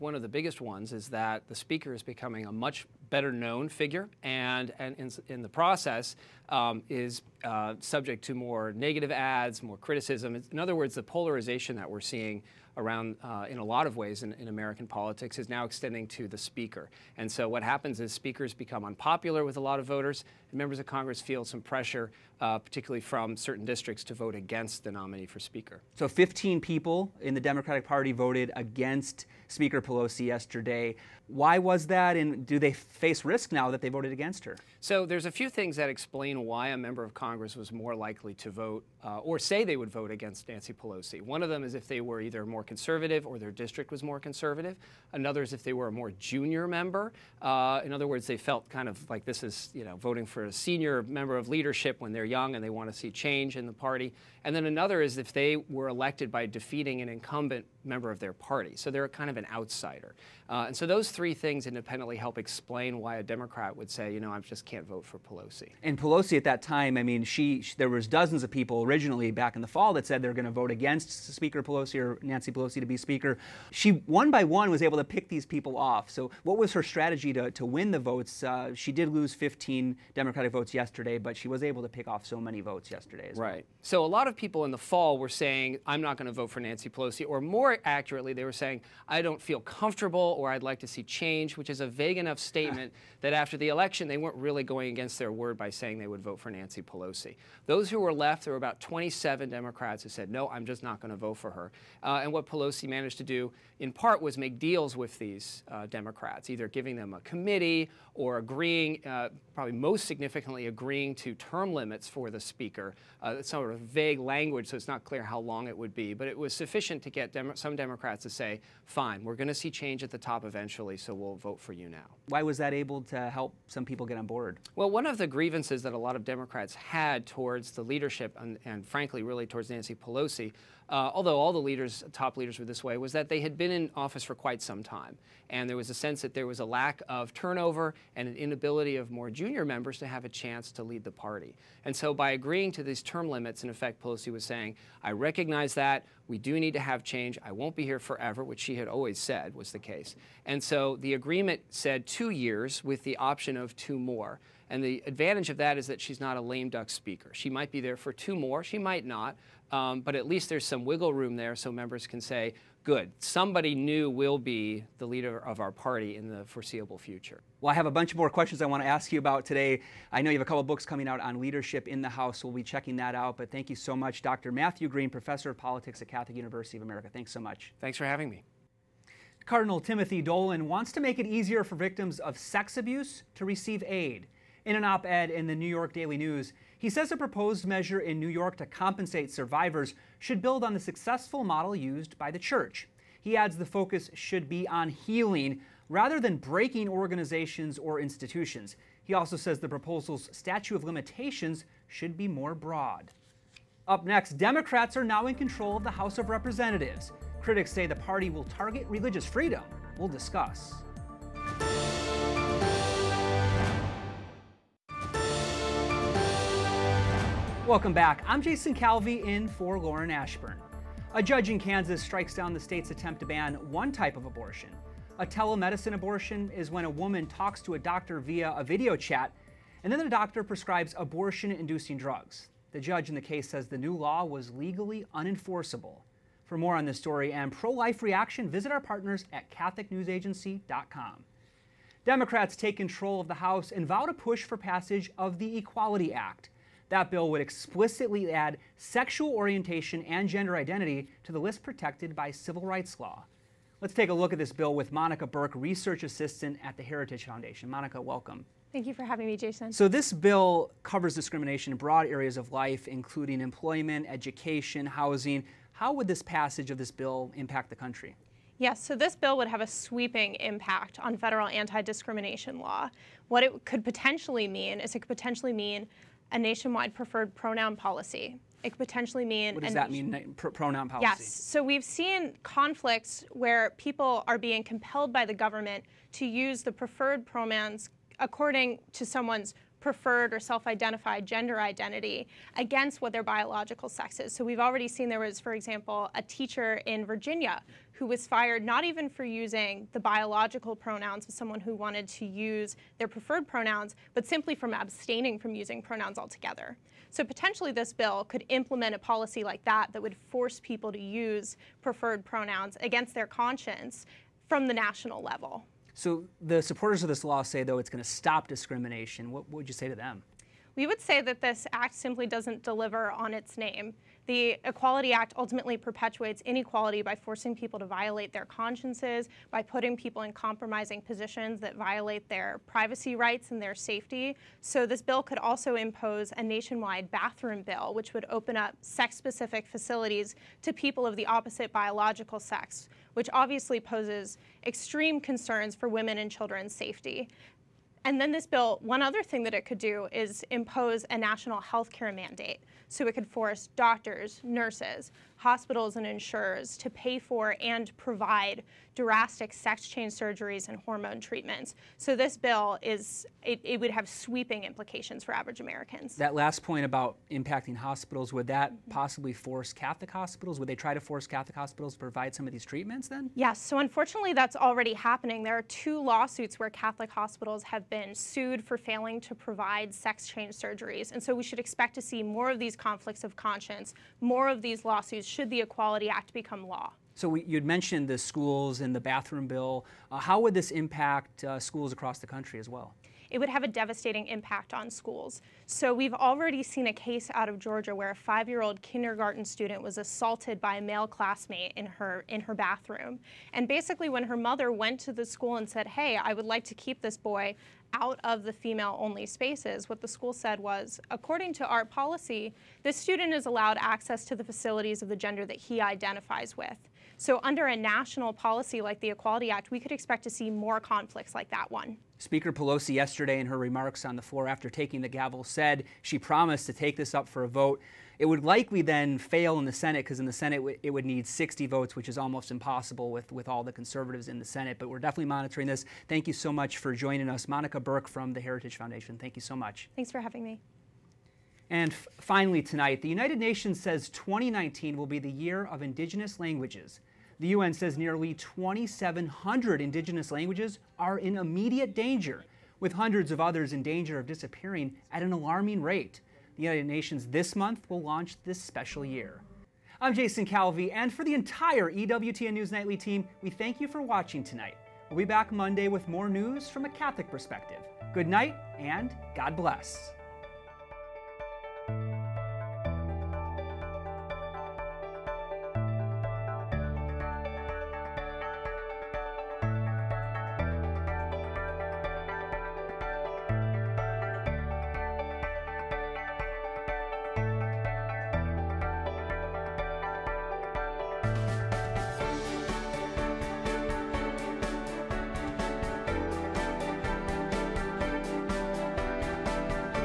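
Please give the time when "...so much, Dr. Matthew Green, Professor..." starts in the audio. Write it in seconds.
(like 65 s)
173 s.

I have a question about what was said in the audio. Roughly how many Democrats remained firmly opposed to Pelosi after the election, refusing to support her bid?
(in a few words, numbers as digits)
27.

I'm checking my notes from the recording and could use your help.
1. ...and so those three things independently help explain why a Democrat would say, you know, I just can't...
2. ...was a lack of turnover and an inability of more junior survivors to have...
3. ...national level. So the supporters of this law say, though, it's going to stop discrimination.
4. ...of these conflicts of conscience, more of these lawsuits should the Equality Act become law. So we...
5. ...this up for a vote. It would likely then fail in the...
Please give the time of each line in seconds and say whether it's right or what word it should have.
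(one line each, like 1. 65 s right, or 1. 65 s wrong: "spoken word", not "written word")
1. 60 s right
2. 136 s wrong: "members", not "survivors"
3. 314 s right
4. 382 s right
5. 426 s right.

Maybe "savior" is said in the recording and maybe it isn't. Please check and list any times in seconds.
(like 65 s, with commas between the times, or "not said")
not said.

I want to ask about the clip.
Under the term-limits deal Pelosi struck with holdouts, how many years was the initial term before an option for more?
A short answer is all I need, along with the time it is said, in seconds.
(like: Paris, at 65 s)
2, at 152 s.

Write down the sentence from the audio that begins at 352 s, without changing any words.
So it could force doctors, nurses, hospitals, and insurers to pay for and provide drastic sex change surgeries and hormone treatments.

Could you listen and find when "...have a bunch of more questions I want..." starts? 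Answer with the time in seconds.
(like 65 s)
167 s.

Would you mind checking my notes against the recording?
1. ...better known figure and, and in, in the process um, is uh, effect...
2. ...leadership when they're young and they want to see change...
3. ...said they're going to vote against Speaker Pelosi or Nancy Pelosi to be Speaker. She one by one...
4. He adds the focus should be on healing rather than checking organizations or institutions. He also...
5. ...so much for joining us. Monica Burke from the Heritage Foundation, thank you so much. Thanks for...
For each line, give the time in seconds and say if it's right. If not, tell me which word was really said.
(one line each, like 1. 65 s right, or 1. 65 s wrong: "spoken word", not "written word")
1. 3 s wrong: "subject", not "effect"
2. 51 s right
3. 70 s right
4. 193 s wrong: "breaking", not "checking"
5. 436 s right.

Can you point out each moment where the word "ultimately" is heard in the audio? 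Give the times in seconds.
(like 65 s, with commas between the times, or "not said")
325 s.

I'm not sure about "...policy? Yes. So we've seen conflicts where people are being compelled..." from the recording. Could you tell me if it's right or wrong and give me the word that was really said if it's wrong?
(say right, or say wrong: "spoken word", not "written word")
right.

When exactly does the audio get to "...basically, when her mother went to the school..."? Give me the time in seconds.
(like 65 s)
403 s.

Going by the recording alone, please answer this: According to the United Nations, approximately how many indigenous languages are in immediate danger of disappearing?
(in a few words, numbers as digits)
2,700.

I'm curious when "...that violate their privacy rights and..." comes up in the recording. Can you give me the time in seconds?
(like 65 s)
331 s.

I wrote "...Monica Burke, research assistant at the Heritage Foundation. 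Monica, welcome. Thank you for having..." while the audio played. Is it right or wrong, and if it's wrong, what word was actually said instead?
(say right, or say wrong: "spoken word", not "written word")
right.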